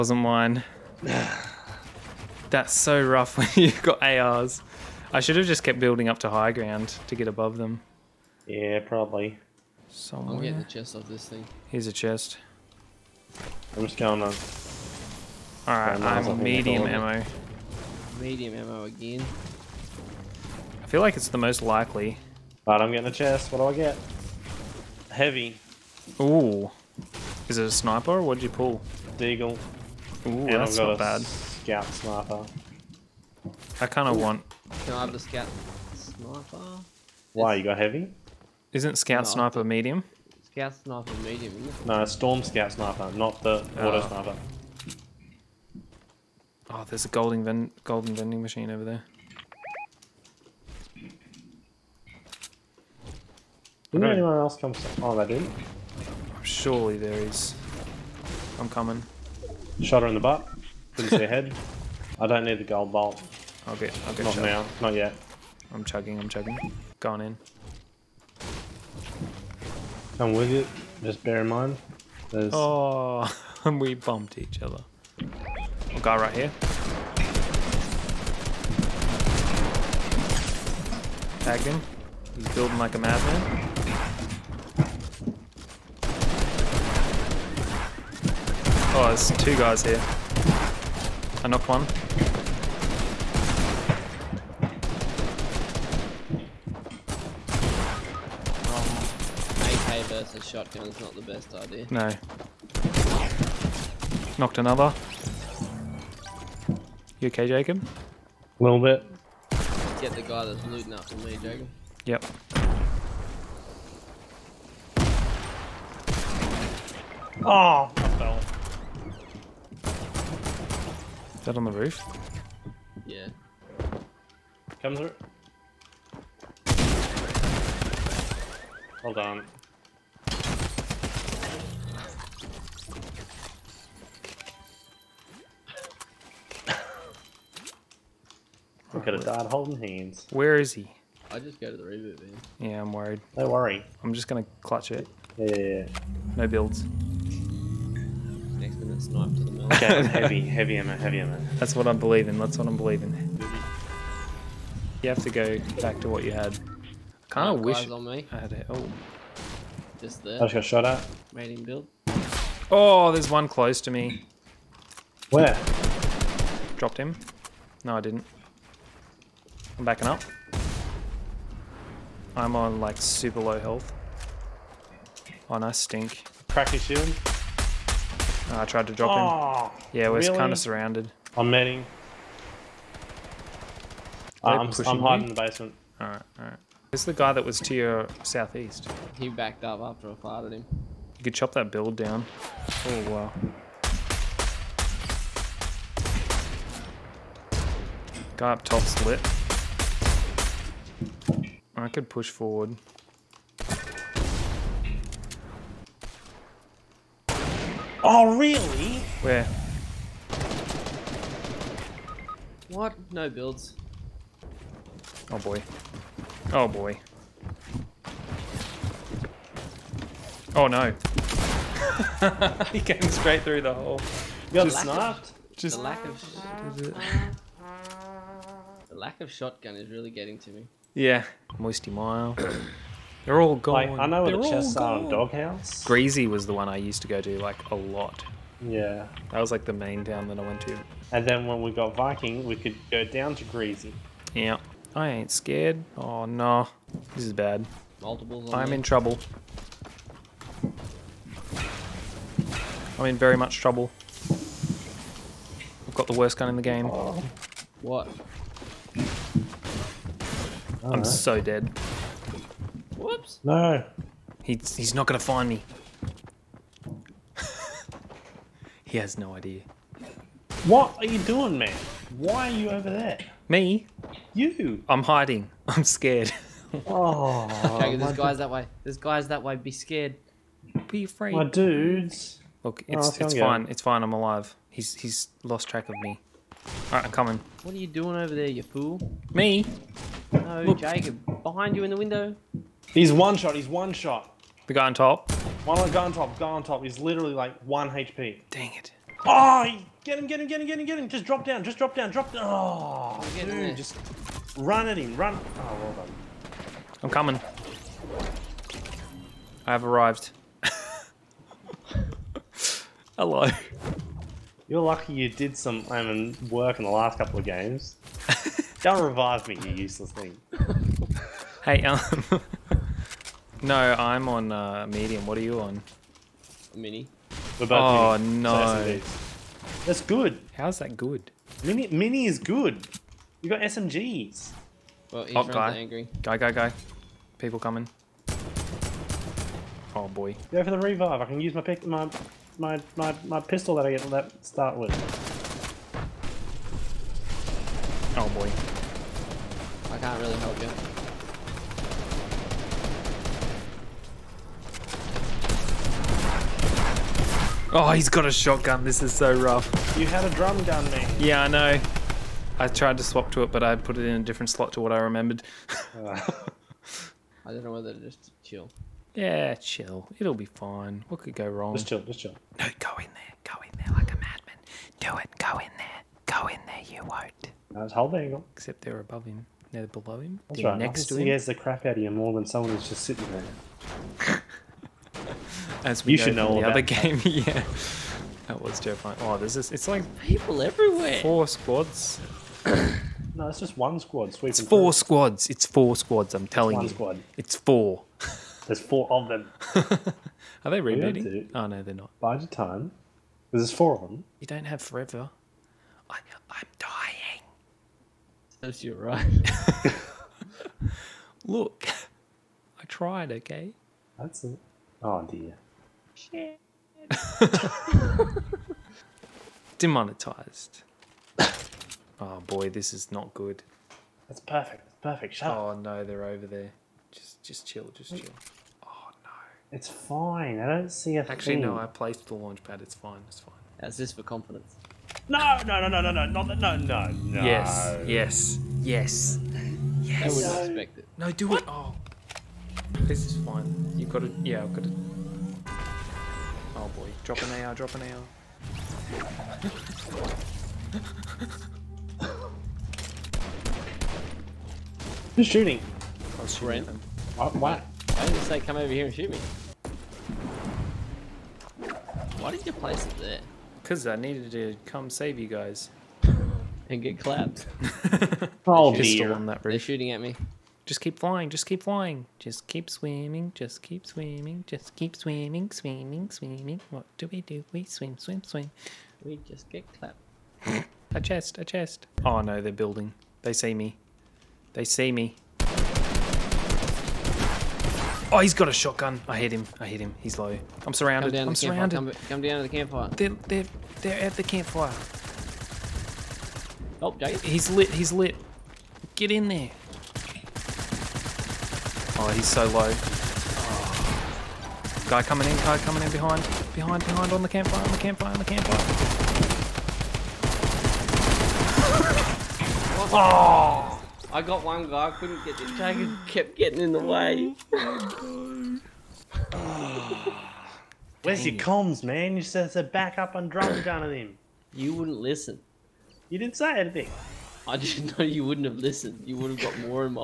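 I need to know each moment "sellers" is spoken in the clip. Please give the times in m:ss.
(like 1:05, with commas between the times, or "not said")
not said.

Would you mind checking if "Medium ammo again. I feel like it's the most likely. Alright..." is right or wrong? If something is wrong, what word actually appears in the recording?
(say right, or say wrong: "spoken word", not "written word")
right.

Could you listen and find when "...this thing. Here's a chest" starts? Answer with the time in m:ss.
0:11.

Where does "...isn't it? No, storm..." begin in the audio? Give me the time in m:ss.
0:41.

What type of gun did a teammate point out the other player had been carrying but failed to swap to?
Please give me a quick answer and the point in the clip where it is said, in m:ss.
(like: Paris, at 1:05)
Drum gun, at 6:00.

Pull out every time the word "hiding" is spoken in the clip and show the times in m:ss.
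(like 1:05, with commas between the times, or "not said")
3:04, 4:35.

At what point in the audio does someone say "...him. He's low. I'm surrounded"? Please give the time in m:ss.
8:09.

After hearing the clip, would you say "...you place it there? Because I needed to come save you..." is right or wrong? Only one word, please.
right.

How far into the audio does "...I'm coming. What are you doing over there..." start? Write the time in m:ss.
4:47.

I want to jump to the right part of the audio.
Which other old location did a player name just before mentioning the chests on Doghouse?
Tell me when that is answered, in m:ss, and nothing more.
3:51.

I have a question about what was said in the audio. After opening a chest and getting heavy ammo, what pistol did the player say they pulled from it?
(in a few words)
Deagle.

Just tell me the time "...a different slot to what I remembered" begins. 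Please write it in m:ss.
6:04.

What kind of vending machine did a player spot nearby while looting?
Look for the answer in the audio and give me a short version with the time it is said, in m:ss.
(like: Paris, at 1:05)
Golden vending machine, at 0:47.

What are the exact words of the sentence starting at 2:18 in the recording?
Look at a dad holding hands.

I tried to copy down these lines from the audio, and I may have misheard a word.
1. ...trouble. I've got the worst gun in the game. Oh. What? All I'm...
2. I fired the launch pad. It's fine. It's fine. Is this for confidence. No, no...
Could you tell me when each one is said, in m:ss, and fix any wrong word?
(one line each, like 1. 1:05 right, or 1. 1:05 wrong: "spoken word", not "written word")
1. 4:13 right
2. 7:11 wrong: "placed", not "fired".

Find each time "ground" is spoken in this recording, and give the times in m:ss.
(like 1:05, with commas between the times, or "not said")
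0:06.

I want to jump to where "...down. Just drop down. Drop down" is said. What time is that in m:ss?
5:01.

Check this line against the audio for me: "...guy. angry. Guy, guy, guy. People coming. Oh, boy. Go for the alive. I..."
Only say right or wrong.
wrong.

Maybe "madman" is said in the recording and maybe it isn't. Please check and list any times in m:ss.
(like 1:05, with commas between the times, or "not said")
1:22, 6:14.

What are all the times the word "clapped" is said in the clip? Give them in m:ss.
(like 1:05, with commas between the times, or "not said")
7:47, 7:59.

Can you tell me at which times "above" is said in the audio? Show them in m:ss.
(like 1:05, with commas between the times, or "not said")
0:07, 6:18.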